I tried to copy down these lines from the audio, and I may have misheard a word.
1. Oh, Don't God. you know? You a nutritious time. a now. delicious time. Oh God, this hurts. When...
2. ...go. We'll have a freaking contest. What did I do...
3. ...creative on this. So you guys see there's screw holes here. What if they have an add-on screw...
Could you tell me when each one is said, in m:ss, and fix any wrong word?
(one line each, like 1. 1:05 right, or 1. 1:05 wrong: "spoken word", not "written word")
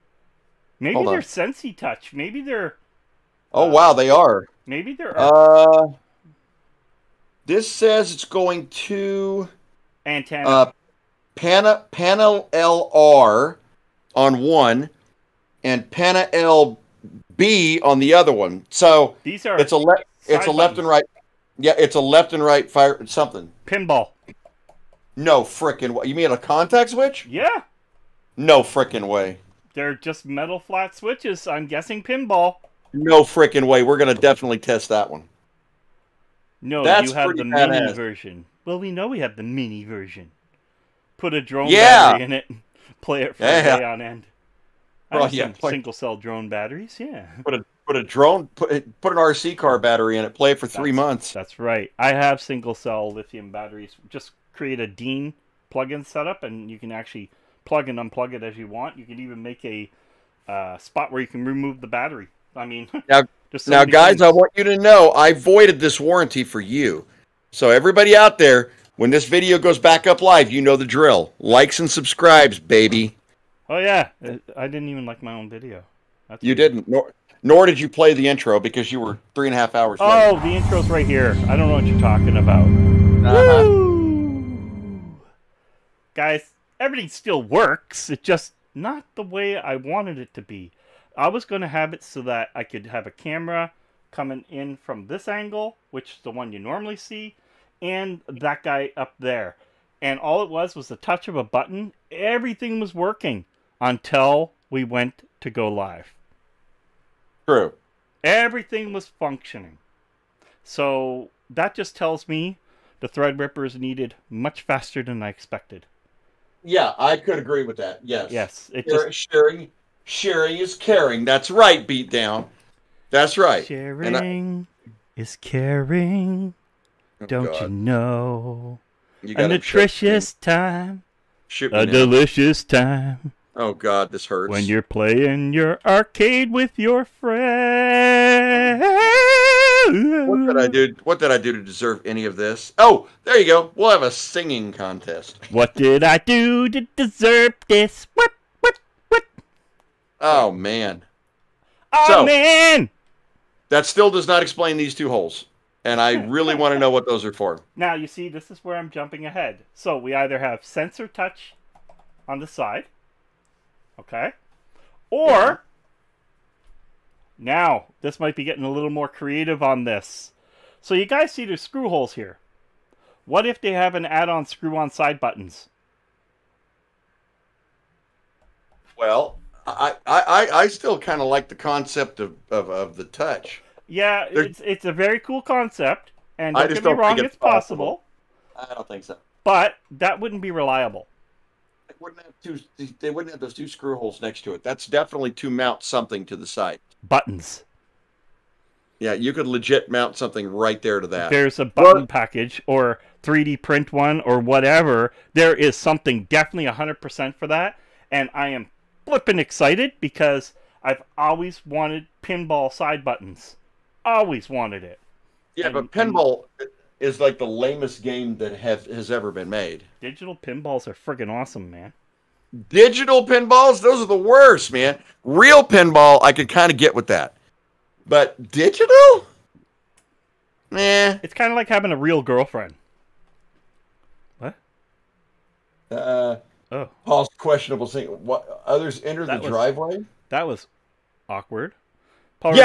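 1. 2:07 right
2. 2:23 wrong: "singing", not "freaking"
3. 2:49 right.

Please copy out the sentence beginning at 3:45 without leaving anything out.
Real pinball, I could kind of get with that.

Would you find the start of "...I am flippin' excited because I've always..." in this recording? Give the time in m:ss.
3:28.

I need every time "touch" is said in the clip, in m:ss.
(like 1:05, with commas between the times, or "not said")
0:01, 1:40, 2:41, 3:03.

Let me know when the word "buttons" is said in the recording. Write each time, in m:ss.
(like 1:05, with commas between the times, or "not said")
0:20, 1:41, 2:55, 3:17, 3:21, 3:33.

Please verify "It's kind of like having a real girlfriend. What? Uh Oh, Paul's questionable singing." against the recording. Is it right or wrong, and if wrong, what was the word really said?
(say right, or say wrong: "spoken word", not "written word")
right.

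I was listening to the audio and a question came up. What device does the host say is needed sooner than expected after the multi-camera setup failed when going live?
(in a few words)
the ripper.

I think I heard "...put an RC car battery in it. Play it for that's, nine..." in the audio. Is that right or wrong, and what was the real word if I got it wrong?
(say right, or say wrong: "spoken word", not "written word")
wrong: "three", not "nine".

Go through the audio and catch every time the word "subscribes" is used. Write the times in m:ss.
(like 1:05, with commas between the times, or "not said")
1:11.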